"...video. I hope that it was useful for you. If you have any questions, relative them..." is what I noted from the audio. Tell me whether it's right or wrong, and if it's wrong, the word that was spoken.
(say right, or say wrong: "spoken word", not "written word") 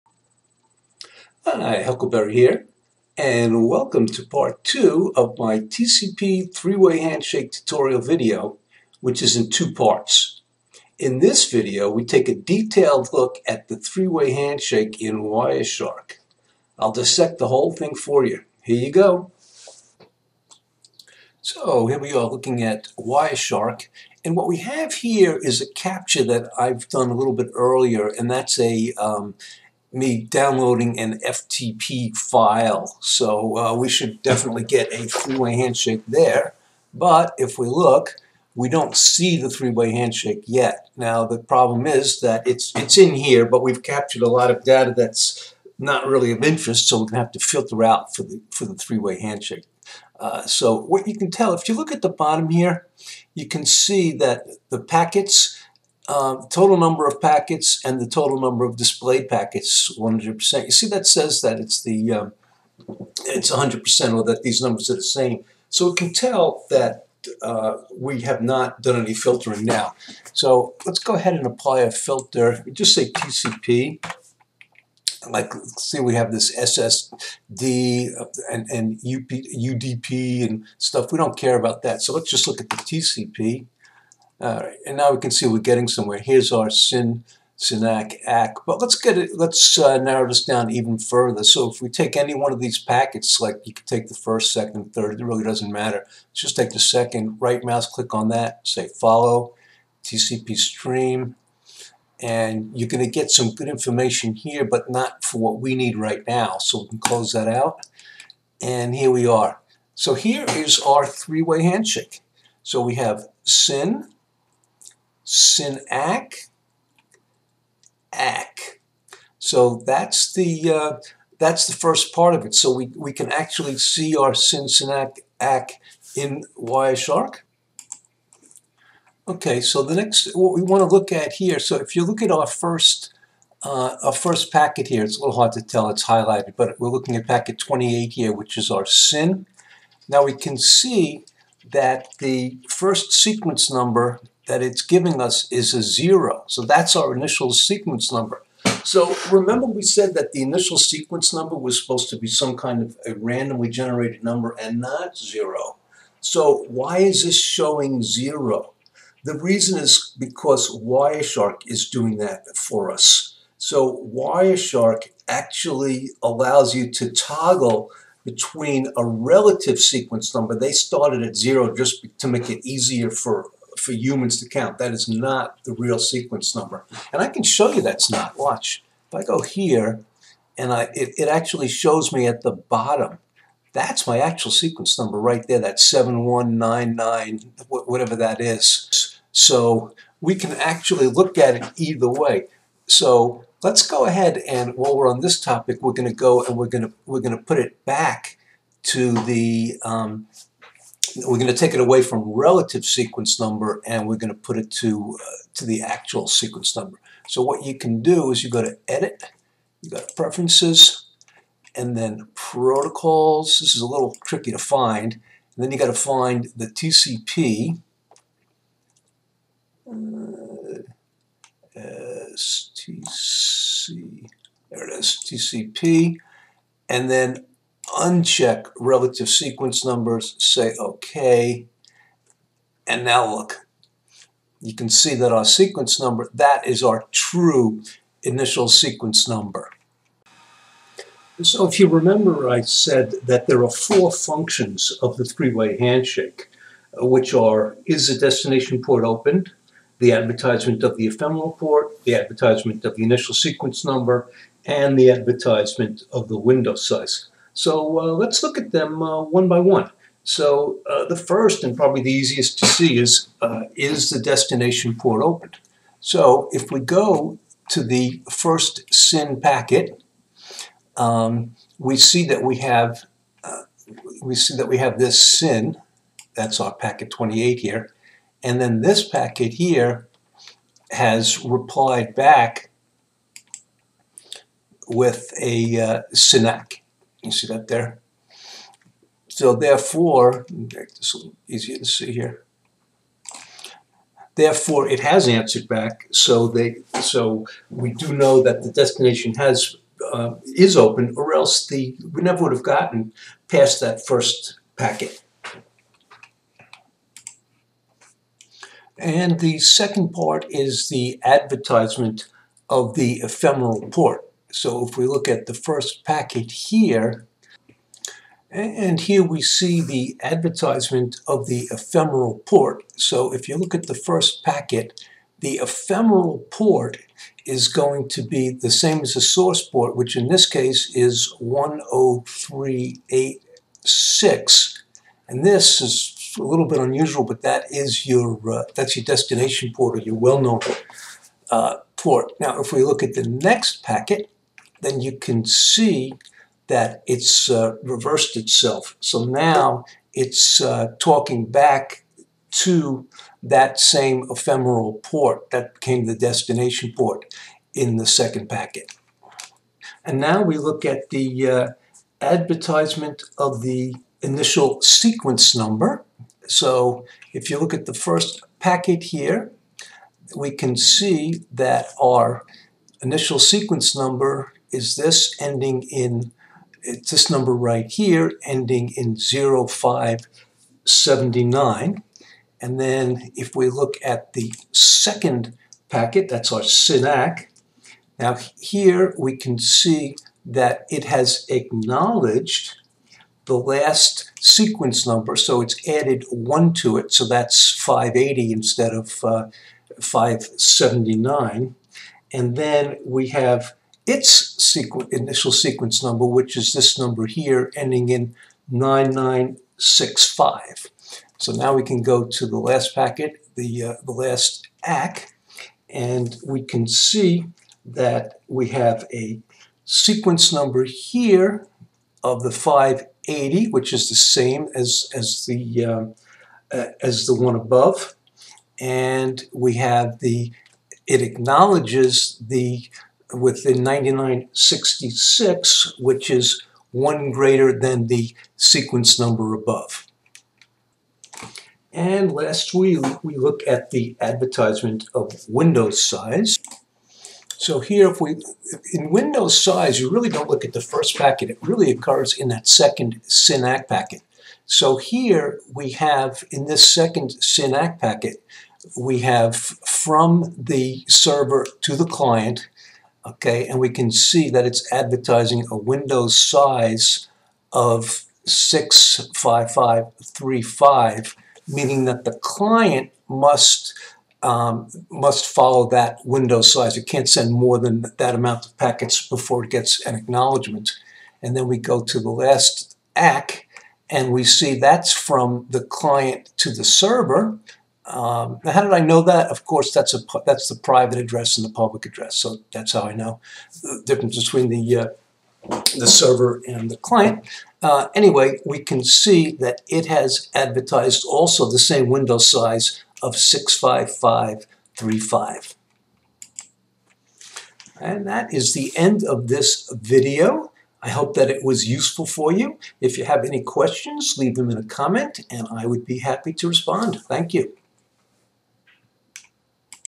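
wrong: "leave", not "relative".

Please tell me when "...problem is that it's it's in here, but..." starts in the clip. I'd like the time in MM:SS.
00:41.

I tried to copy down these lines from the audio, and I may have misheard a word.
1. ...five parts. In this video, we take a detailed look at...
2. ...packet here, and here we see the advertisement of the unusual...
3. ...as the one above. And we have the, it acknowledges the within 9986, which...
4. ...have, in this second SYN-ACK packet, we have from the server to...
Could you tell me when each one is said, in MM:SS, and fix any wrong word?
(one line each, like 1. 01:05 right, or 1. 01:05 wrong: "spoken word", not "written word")
1. 00:09 wrong: "two", not "five"
2. 05:16 wrong: "ephemeral", not "unusual"
3. 07:07 wrong: "9966", not "9986"
4. 07:35 right.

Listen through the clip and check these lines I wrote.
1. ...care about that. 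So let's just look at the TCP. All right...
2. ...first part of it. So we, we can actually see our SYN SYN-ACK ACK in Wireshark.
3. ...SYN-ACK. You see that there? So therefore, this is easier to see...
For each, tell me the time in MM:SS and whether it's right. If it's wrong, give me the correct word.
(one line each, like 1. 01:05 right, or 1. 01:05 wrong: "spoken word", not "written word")
1. 01:21 right
2. 02:01 right
3. 04:46 right.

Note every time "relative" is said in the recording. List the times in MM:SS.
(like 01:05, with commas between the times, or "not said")
02:49, 03:22, 03:48.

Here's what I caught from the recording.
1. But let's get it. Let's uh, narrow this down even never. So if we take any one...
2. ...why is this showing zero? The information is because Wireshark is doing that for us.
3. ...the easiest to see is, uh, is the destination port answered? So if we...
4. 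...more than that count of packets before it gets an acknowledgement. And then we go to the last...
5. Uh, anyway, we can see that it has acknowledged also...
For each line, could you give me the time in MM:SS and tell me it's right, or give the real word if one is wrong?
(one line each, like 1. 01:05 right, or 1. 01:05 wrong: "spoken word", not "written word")
1. 01:28 wrong: "further", not "never"
2. 02:36 wrong: "reason", not "information"
3. 04:22 wrong: "opened", not "answered"
4. 07:57 wrong: "amount", not "count"
5. 08:17 wrong: "advertised", not "acknowledged".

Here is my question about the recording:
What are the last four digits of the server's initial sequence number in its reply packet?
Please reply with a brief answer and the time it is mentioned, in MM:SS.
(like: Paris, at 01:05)
9965, at 06:48.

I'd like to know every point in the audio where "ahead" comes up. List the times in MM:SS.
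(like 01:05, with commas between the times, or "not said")
01:11, 03:14.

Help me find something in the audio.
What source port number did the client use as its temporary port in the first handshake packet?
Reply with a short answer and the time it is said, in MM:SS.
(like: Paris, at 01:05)
10386, at 05:31.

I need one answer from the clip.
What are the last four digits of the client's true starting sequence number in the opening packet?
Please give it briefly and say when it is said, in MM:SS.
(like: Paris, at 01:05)
0579, at 06:19.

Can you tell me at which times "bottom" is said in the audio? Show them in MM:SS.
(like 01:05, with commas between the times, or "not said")
00:52, 03:02.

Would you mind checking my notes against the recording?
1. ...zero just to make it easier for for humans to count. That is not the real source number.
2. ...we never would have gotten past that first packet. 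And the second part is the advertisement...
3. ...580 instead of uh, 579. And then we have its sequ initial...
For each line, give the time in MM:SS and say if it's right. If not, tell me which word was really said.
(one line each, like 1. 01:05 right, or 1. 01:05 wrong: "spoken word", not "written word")
1. 02:51 wrong: "sequence", not "source"
2. 05:02 right
3. 06:37 right.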